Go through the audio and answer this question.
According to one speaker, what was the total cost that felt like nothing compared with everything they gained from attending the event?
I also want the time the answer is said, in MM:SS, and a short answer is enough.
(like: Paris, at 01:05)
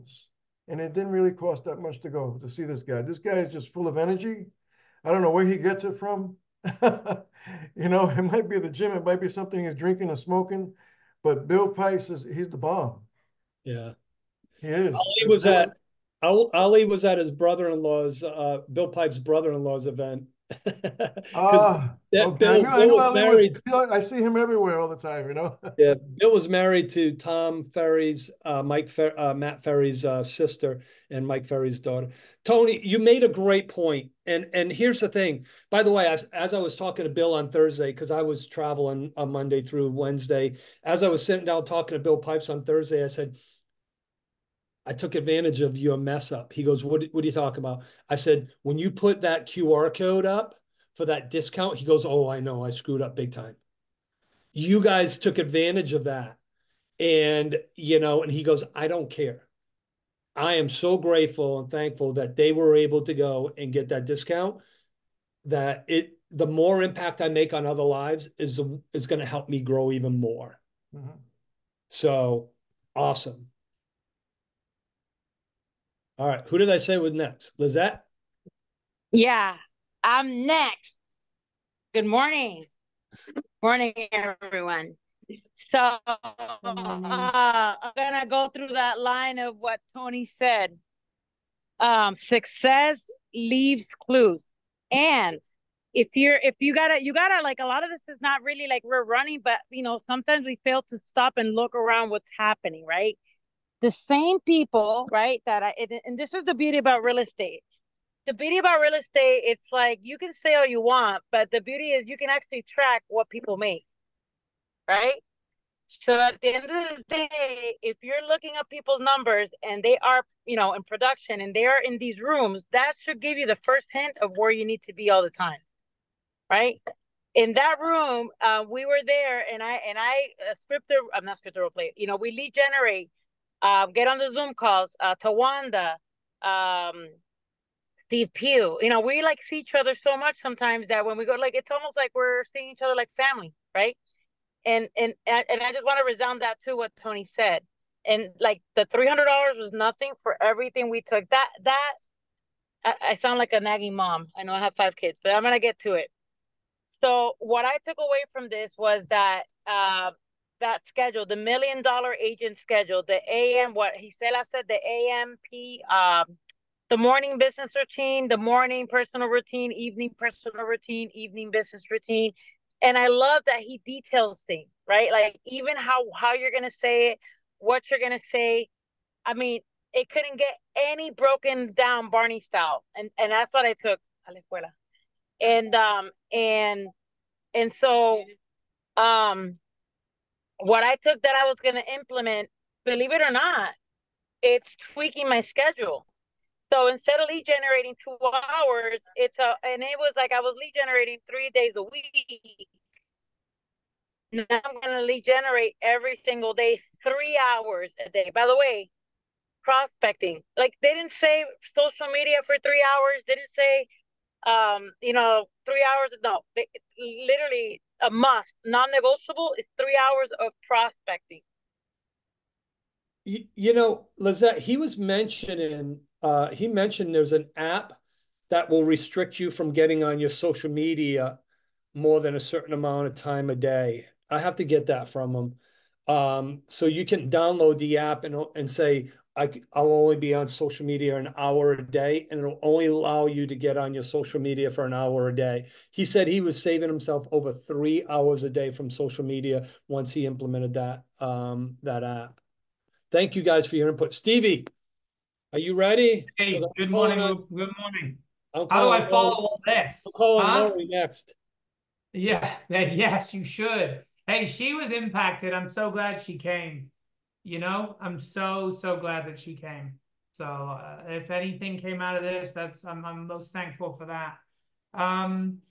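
$300, at 02:28.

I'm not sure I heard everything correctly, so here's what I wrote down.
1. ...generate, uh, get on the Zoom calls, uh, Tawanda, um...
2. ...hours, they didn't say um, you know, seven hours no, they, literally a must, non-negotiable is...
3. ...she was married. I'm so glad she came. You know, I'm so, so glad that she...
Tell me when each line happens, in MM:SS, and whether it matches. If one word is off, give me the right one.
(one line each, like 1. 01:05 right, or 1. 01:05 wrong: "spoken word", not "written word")
1. 02:12 right
2. 03:32 wrong: "three", not "seven"
3. 04:24 wrong: "impacted", not "married".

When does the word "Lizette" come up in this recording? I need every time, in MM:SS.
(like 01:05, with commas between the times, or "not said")
01:17, 03:44.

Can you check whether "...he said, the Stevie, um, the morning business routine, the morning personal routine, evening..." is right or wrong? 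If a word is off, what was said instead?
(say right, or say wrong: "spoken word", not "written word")
wrong: "AMP", not "Stevie".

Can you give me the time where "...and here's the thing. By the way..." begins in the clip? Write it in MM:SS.
00:34.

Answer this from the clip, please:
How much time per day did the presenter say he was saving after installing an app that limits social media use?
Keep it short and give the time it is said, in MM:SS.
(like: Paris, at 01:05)
Over 3 hours, at 04:07.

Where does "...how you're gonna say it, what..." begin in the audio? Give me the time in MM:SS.
02:56.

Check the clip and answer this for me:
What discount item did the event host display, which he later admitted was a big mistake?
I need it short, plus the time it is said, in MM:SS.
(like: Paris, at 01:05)
QR code, at 00:49.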